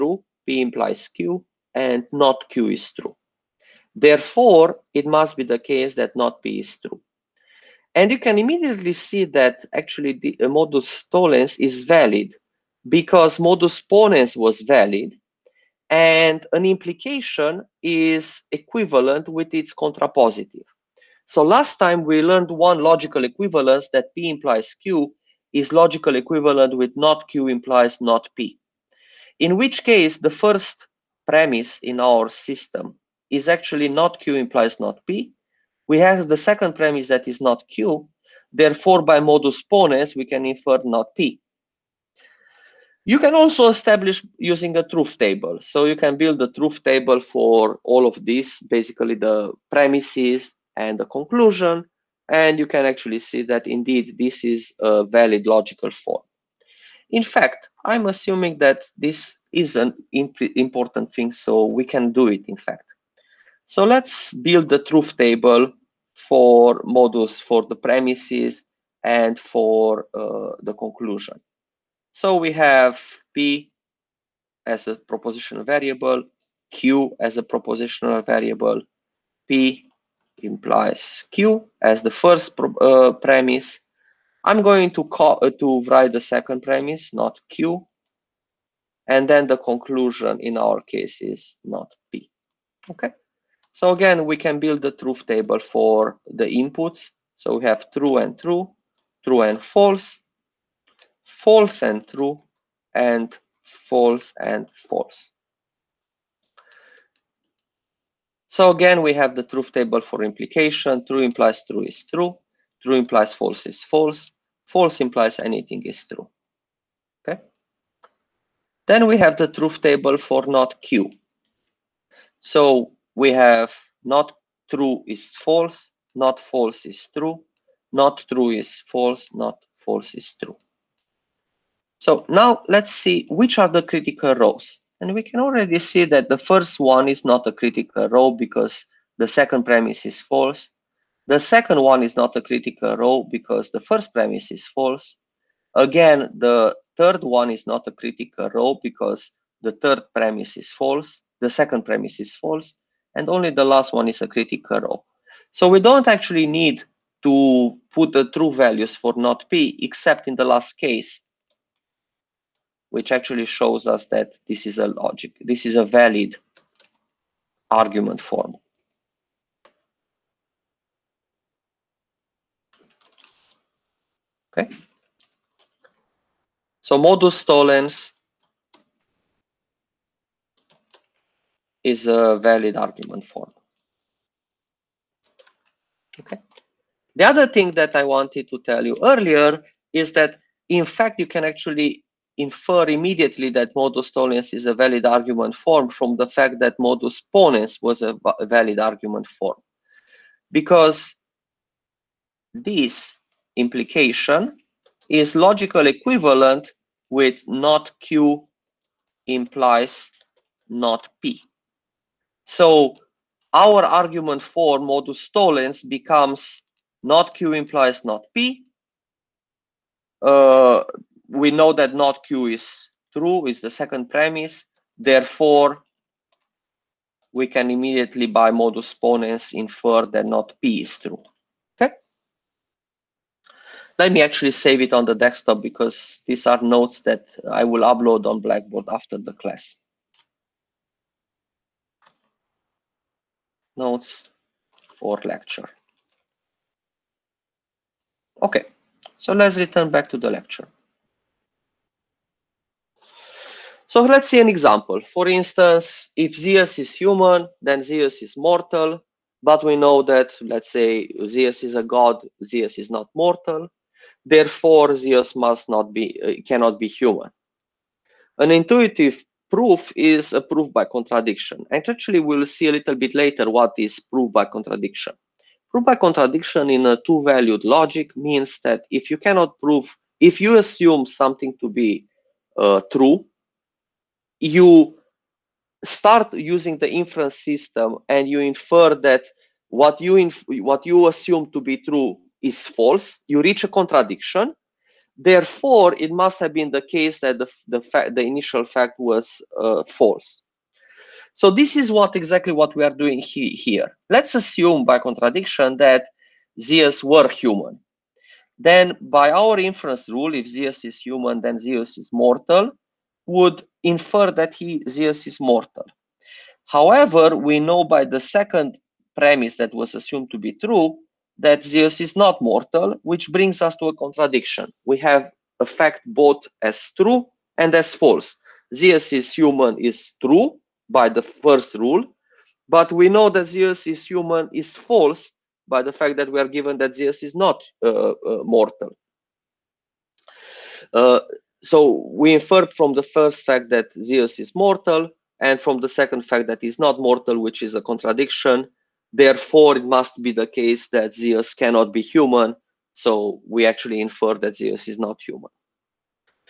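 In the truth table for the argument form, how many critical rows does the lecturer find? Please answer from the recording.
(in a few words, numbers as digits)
1.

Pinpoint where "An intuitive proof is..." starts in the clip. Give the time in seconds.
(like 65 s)
268 s.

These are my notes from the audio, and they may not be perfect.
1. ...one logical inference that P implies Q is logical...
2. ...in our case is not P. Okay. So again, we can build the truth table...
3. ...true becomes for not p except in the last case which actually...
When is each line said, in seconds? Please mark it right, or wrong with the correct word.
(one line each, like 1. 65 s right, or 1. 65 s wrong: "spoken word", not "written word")
1. 22 s wrong: "equivalence", not "inference"
2. 90 s right
3. 158 s wrong: "values", not "becomes".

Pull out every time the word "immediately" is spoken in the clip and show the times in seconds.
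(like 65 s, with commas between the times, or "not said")
8 s, 192 s, 227 s.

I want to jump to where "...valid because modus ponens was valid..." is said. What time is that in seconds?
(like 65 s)
11 s.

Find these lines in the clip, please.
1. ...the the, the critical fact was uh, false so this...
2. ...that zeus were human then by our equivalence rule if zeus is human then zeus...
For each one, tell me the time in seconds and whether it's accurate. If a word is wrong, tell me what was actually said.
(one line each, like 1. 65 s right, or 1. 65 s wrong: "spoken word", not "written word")
1. 297 s wrong: "initial", not "critical"
2. 305 s wrong: "inference", not "equivalence".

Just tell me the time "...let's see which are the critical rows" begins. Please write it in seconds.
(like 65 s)
132 s.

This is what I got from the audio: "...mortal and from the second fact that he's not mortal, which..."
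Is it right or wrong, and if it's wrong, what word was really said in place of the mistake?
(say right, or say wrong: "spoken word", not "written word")
right.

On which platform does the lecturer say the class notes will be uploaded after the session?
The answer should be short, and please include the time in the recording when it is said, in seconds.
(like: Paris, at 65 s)
Blackboard, at 238 s.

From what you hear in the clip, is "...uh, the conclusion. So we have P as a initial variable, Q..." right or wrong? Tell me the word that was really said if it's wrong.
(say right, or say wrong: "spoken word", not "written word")
wrong: "propositional", not "initial".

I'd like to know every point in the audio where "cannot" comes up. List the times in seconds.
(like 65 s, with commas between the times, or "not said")
266 s, 279 s, 351 s.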